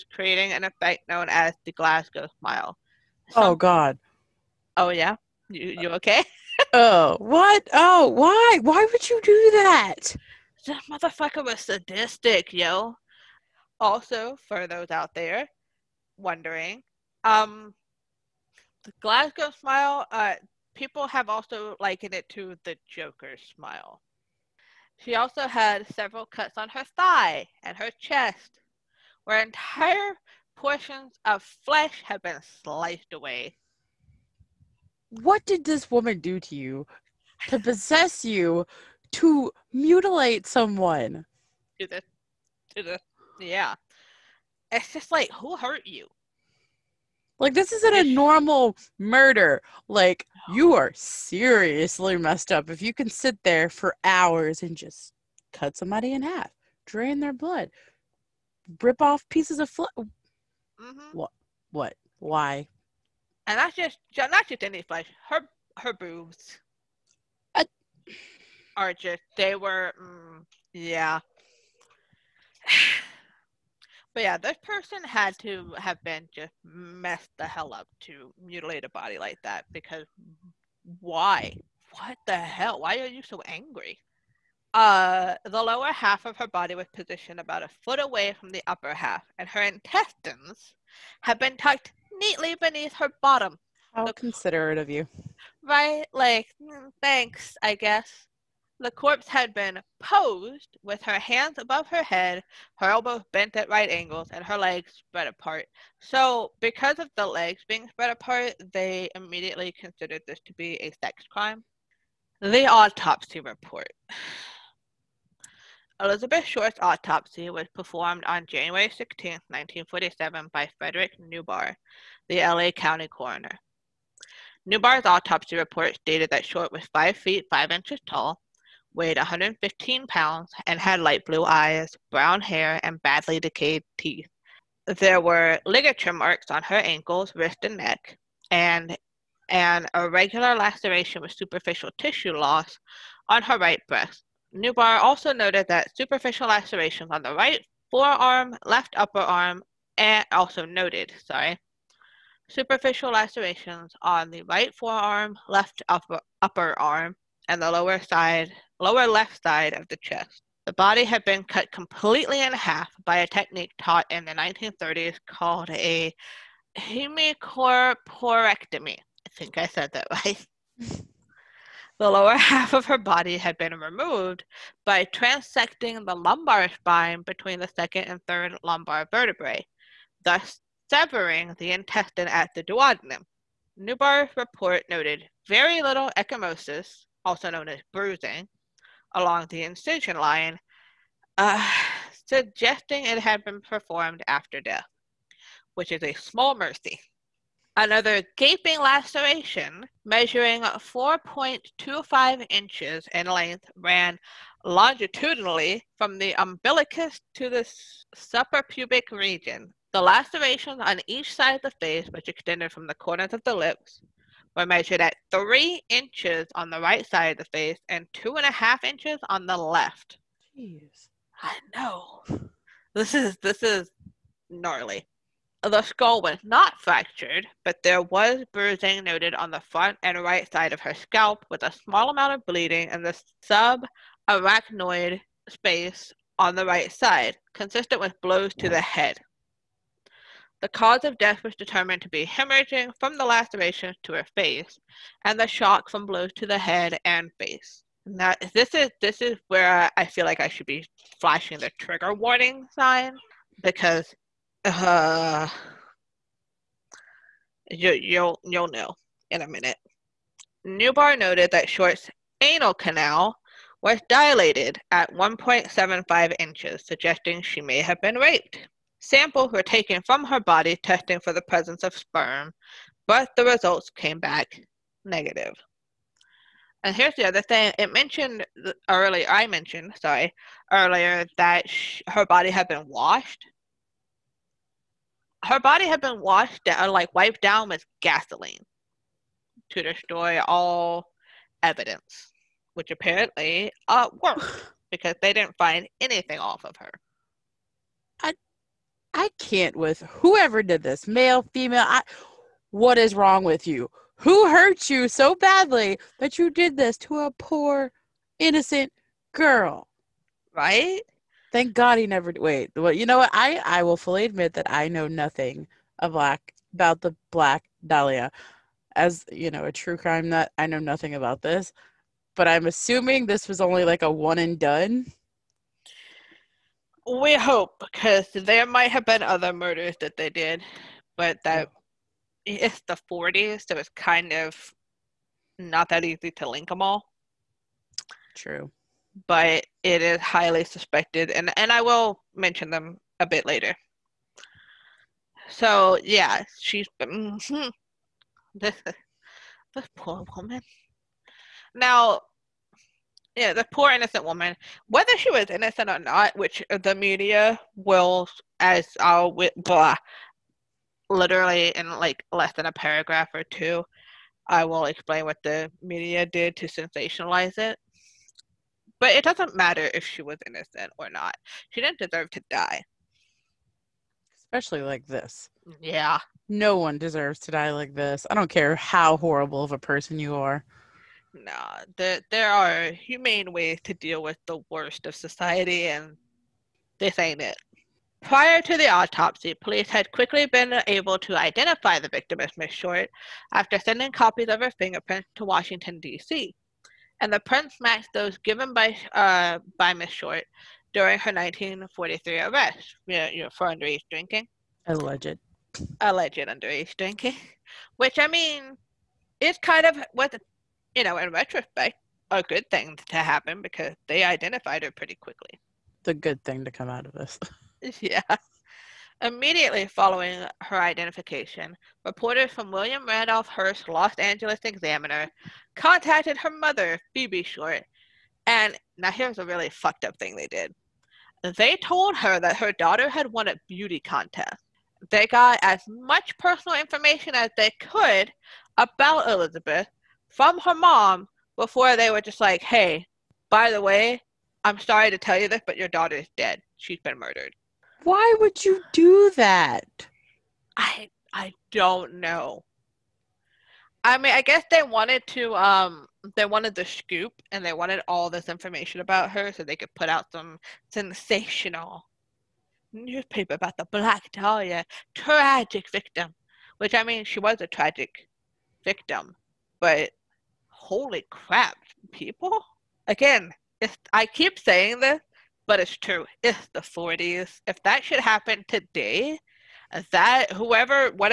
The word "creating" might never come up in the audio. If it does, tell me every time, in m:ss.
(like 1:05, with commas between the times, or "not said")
0:00.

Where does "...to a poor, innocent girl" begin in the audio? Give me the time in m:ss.
5:06.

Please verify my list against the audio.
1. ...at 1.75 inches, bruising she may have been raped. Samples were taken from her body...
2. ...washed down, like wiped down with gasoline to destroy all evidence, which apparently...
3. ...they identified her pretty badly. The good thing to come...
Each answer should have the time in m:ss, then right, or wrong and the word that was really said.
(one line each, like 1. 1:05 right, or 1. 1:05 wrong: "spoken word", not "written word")
1. 4:24 wrong: "suggesting", not "bruising"
2. 4:46 right
3. 6:54 wrong: "quickly", not "badly".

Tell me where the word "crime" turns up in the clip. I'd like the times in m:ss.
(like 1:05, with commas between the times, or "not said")
1:51, 5:19.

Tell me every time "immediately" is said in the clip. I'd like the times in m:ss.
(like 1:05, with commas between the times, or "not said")
1:49, 6:59.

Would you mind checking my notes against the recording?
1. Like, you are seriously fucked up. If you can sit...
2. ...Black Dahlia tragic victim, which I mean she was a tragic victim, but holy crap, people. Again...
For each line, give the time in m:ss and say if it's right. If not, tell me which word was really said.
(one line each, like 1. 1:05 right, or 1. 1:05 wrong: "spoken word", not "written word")
1. 0:49 wrong: "messed", not "fucked"
2. 7:43 right.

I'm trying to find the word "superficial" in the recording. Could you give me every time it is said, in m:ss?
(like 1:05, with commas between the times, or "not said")
2:21, 2:25, 2:32.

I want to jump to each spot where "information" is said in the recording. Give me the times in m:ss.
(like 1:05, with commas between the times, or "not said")
7:16, 7:38.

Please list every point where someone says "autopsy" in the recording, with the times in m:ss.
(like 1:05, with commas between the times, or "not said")
1:52, 1:56, 2:05, 6:28.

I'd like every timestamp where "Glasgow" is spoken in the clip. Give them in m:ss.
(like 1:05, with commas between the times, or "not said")
0:01, 0:19.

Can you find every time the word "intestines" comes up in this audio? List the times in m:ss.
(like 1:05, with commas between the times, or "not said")
1:29, 3:01.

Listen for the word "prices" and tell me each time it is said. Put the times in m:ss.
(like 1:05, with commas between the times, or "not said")
not said.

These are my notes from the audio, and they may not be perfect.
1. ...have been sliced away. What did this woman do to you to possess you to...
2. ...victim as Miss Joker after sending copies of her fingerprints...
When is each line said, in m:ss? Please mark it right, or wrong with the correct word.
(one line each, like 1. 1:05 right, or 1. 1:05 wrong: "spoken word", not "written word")
1. 0:32 right
2. 6:32 wrong: "Short", not "Joker".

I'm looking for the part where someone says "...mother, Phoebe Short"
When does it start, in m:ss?
7:06.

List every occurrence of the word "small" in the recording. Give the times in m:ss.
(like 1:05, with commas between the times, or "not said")
3:16, 3:51.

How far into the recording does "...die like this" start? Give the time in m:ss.
6:17.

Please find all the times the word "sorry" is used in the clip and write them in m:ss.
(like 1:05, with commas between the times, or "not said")
2:31, 4:40, 7:24.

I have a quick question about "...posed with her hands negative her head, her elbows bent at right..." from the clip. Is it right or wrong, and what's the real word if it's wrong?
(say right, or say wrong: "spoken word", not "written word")
wrong: "above", not "negative".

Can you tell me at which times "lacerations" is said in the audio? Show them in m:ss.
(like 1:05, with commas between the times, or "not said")
2:20, 2:26, 2:33, 3:18, 3:30, 4:03.